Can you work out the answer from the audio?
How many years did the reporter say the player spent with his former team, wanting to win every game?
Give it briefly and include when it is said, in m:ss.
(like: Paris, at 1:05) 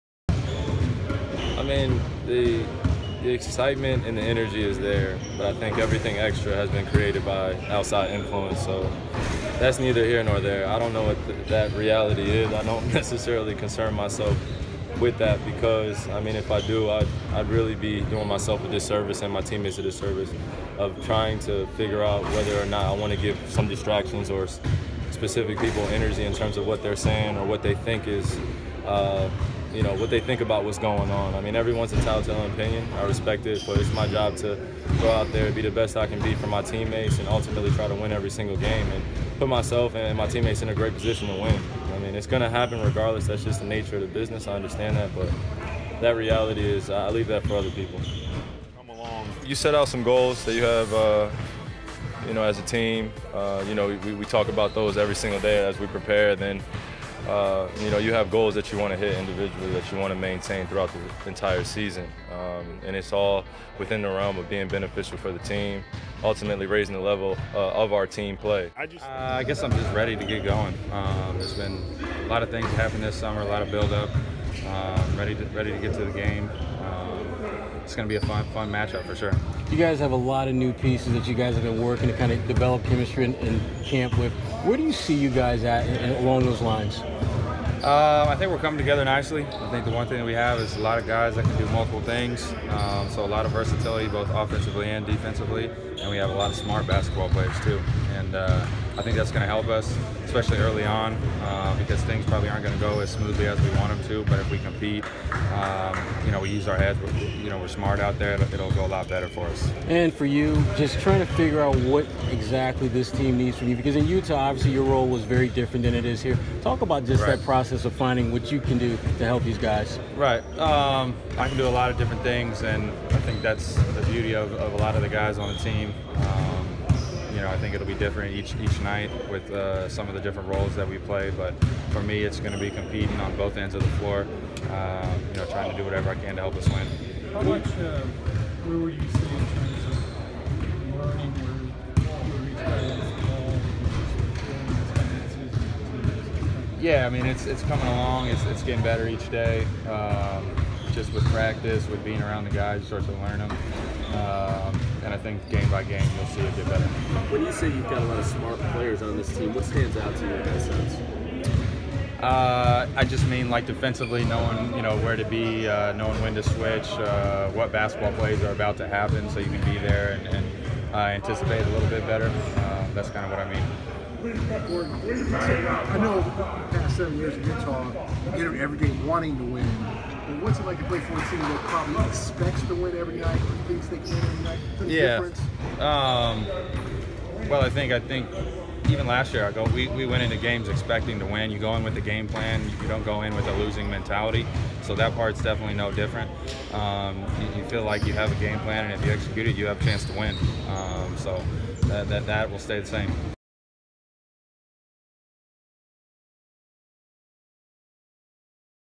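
7, at 2:56.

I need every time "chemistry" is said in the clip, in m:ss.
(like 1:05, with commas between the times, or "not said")
1:22.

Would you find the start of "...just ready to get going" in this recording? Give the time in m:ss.
1:09.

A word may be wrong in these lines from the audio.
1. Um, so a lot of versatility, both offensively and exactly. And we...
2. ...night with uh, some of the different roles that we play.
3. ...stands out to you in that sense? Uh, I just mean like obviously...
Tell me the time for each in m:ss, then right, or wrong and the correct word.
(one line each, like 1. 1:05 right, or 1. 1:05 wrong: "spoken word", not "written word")
1. 1:32 wrong: "defensively", not "exactly"
2. 2:08 right
3. 2:39 wrong: "defensively", not "obviously".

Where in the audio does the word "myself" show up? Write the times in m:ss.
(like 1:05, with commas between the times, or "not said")
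0:13, 0:18, 0:39.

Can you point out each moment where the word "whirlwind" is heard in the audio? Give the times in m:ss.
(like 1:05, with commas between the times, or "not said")
not said.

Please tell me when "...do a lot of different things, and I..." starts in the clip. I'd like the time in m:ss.
2:01.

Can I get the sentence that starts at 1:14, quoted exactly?
up uh, ready to ready to get to the game it's going to be a fun, fun matchup for sure.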